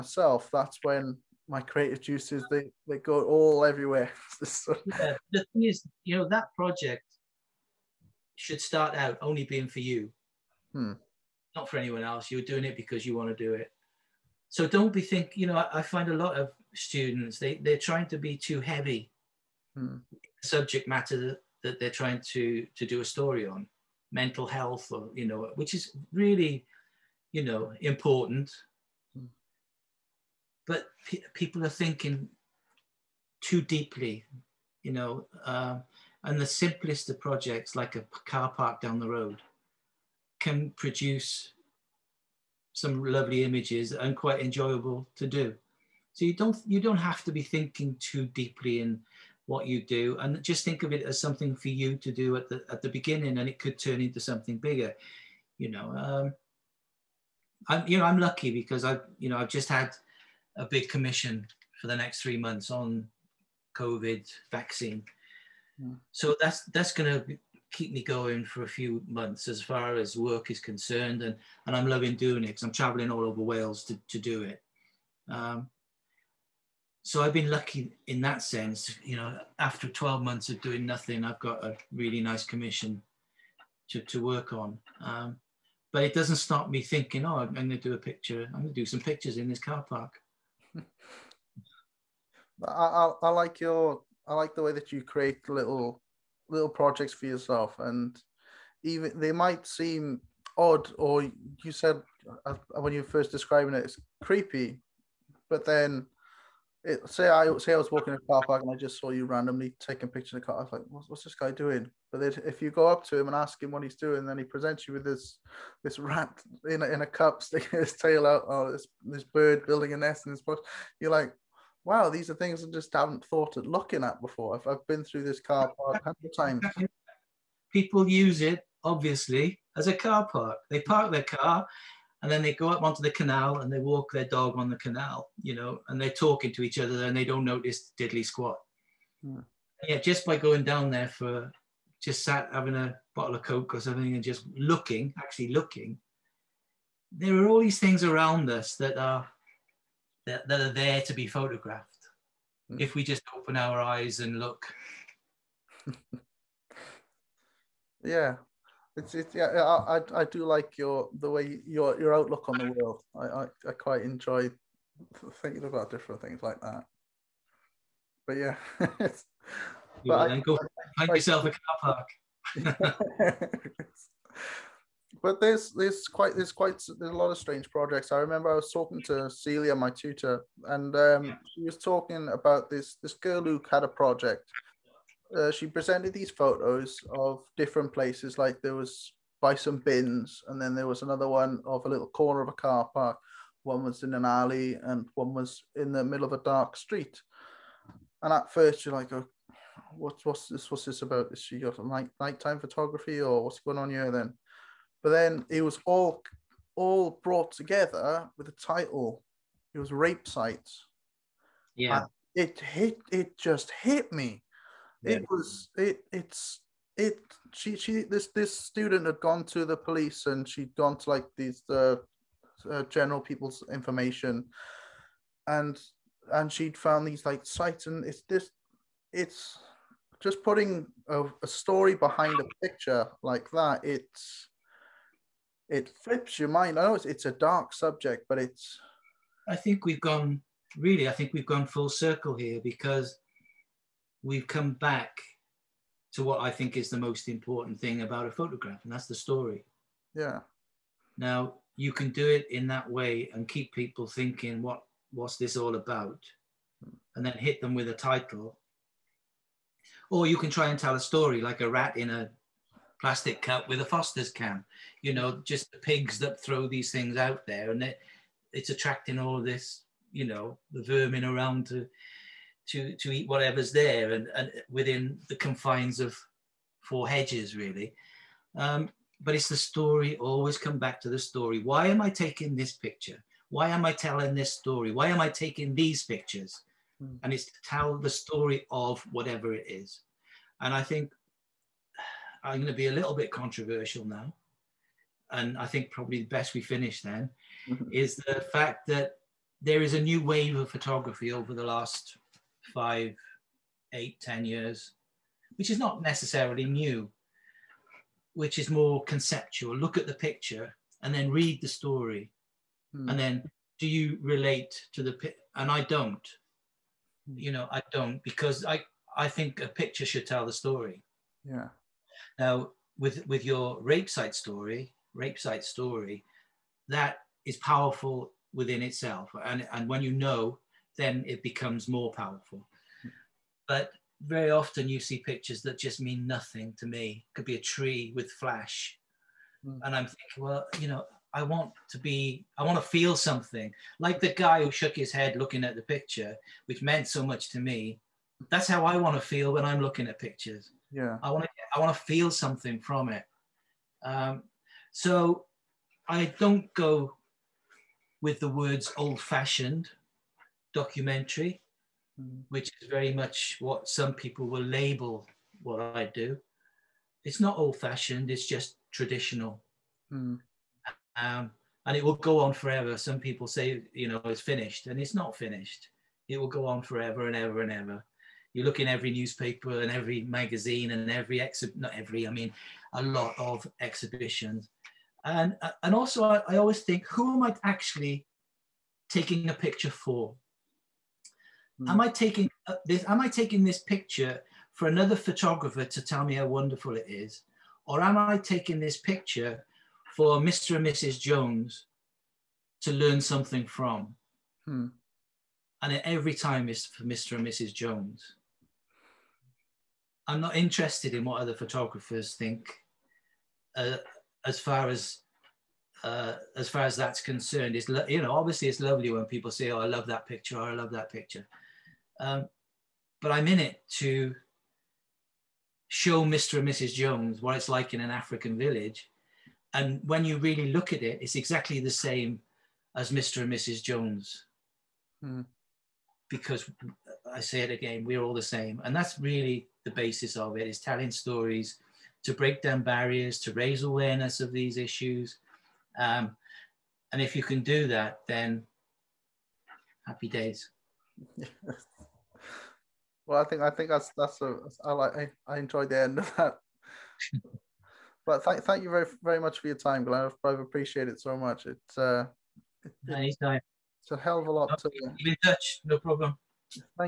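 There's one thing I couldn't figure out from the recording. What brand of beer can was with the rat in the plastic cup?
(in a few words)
Foster's.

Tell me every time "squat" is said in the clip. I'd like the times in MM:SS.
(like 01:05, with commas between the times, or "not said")
02:18.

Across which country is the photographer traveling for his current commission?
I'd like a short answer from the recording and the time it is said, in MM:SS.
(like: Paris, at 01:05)
Wales, at 01:13.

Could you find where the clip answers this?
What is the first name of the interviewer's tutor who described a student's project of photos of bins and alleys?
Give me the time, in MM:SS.
02:59.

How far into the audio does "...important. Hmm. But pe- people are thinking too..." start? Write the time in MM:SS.
00:27.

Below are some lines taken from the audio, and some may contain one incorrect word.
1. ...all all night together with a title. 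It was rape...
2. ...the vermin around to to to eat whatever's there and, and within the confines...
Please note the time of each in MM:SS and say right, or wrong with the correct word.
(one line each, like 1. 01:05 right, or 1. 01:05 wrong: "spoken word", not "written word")
1. 03:25 wrong: "brought", not "night"
2. 04:30 right.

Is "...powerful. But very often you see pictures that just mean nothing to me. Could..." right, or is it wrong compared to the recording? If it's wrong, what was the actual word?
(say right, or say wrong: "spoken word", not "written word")
right.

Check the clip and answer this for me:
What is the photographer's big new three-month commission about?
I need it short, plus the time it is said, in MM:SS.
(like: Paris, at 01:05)
COVID vaccine, at 01:03.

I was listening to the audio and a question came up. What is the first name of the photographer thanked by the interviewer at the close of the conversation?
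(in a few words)
Glenn.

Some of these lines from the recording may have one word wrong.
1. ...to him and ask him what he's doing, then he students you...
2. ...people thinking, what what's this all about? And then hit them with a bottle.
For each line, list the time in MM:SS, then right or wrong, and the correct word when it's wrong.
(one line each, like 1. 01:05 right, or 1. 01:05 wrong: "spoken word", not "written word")
1. 01:53 wrong: "presents", not "students"
2. 04:13 wrong: "title", not "bottle".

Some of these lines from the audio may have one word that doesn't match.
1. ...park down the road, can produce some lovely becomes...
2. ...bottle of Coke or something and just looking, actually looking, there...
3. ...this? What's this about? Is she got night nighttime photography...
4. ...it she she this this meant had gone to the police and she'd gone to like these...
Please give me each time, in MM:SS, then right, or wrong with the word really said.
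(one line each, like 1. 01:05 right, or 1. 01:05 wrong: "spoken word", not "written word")
1. 00:38 wrong: "images", not "becomes"
2. 02:23 right
3. 03:20 right
4. 03:36 wrong: "student", not "meant".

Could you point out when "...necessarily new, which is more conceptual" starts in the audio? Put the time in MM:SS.
05:06.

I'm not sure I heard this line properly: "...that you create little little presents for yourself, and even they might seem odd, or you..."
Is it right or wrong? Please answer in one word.
wrong.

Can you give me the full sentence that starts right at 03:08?
Like there was by some bins, and then there was another one of a little corner of a car park.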